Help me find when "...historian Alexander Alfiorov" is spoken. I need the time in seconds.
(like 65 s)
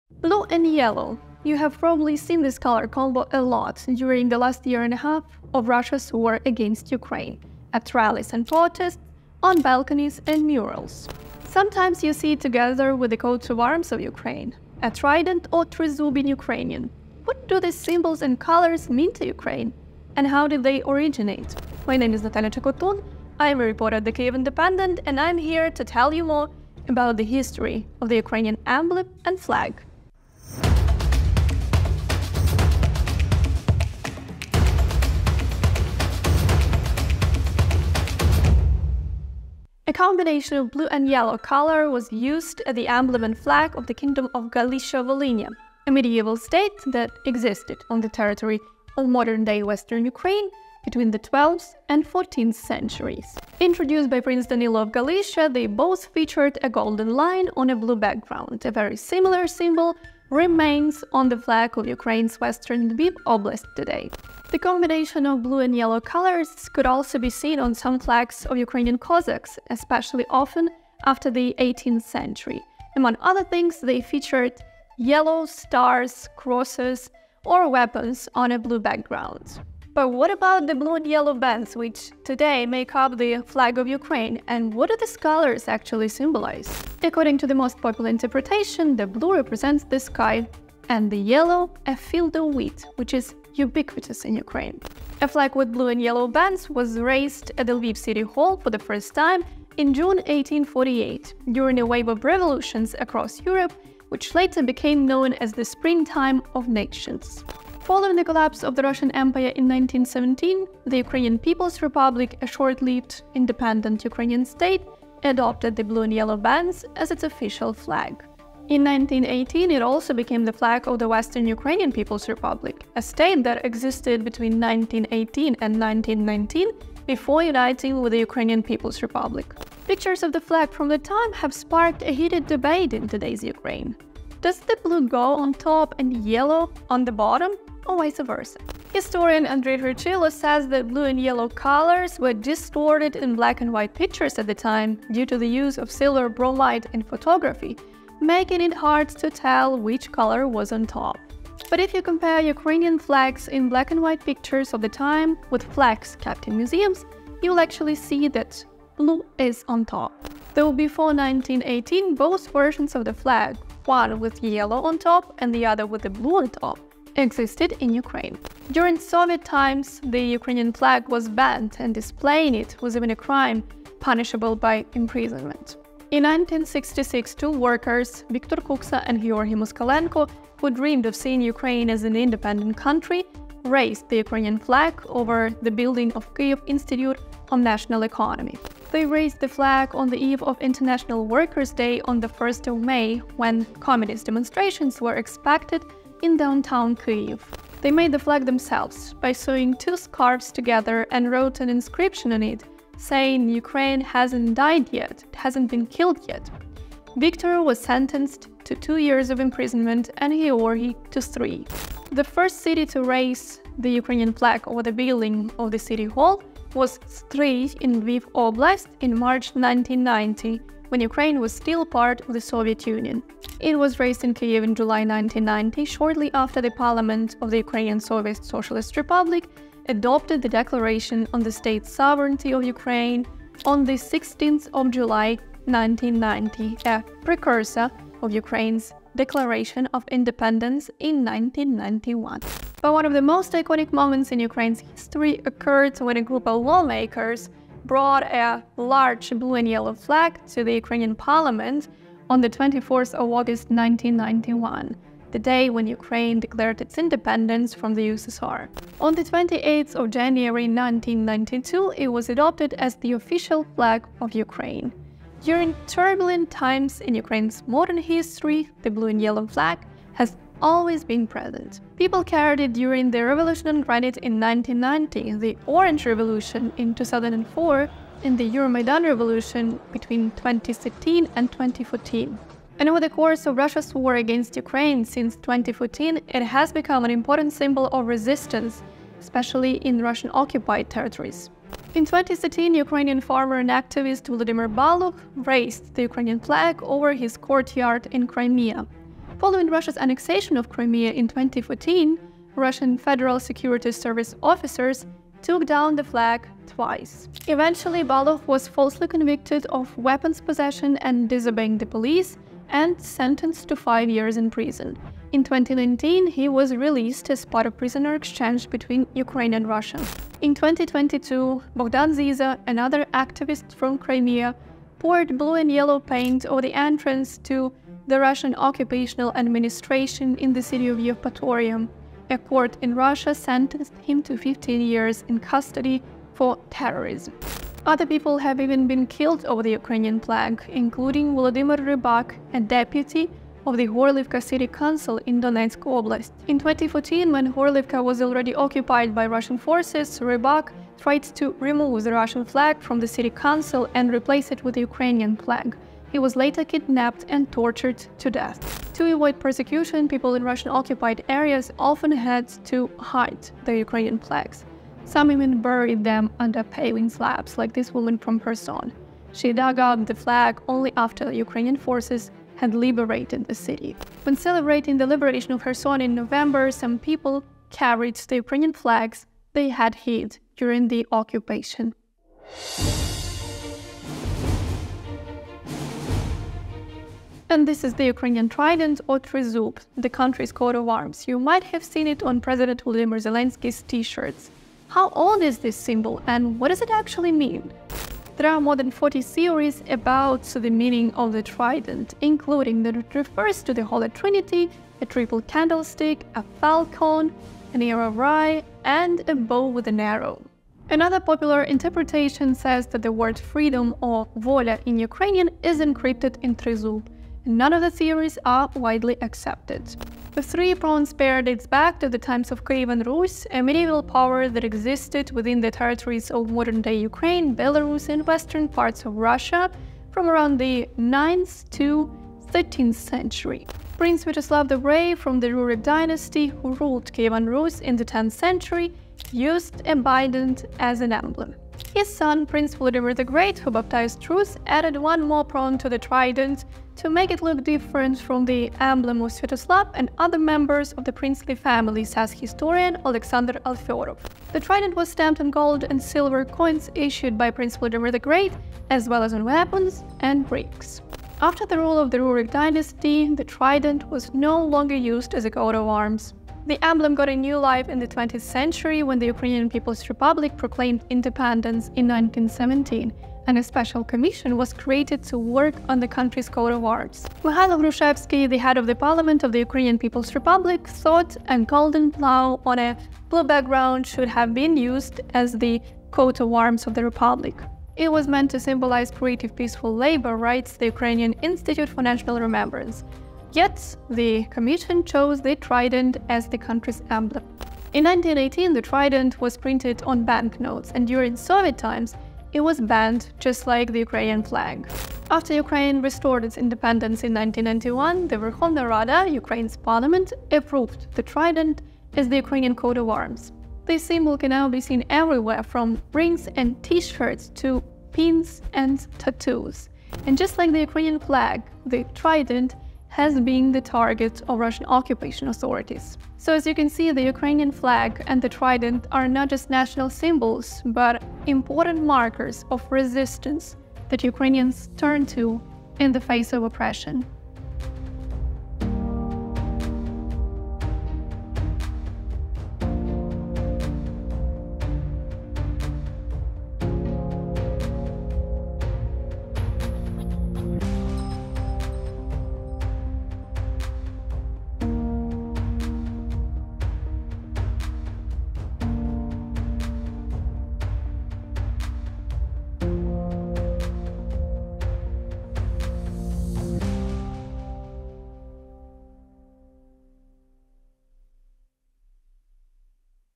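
452 s.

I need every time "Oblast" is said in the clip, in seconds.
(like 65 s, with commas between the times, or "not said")
63 s, 218 s, 345 s.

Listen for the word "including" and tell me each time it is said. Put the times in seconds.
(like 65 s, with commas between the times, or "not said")
340 s, 402 s.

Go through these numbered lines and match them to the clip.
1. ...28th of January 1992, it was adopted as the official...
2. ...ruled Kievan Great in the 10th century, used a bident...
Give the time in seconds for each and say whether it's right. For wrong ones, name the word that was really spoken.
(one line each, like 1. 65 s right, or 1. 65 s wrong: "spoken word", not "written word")
1. 259 s right
2. 436 s wrong: "Rus", not "Great".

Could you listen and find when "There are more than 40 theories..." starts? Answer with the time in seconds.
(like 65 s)
398 s.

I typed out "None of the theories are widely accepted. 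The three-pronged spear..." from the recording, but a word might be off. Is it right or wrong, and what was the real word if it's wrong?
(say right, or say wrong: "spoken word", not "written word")
right.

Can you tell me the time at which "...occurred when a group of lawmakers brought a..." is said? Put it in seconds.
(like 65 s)
245 s.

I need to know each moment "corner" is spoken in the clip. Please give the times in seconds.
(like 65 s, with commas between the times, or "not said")
not said.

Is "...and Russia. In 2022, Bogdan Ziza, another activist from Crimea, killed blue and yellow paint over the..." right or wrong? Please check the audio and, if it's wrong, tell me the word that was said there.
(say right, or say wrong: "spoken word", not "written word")
wrong: "poured", not "killed".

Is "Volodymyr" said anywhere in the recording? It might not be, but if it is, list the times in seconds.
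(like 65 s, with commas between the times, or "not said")
341 s, 392 s.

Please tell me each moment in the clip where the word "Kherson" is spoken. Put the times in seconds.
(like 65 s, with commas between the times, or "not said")
368 s, 375 s.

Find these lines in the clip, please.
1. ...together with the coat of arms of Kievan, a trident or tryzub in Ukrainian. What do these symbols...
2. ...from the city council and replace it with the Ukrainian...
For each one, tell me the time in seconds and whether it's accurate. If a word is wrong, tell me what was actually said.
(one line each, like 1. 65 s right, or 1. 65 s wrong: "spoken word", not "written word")
1. 12 s wrong: "Ukraine", not "Kievan"
2. 352 s right.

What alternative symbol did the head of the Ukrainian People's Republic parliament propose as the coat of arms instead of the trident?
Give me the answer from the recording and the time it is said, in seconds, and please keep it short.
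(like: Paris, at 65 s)
A golden plow, at 481 s.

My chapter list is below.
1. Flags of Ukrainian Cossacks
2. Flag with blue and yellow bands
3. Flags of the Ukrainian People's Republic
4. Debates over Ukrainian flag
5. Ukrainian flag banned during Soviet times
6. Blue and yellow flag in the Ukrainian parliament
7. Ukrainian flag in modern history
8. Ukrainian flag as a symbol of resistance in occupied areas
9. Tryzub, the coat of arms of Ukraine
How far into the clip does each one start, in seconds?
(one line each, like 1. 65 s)
1. 64 s
2. 91 s
3. 108 s
4. 130 s
5. 168 s
6. 243 s
7. 265 s
8. 283 s
9. 385 s.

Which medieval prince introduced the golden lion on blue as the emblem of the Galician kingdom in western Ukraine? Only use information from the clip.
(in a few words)
Danilo of Galicia.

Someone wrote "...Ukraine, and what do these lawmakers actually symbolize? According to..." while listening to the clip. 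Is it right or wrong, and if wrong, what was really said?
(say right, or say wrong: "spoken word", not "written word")
wrong: "colors", not "lawmakers".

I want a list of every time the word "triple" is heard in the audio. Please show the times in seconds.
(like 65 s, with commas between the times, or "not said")
405 s.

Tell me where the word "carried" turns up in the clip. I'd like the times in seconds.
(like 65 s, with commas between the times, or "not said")
272 s, 377 s.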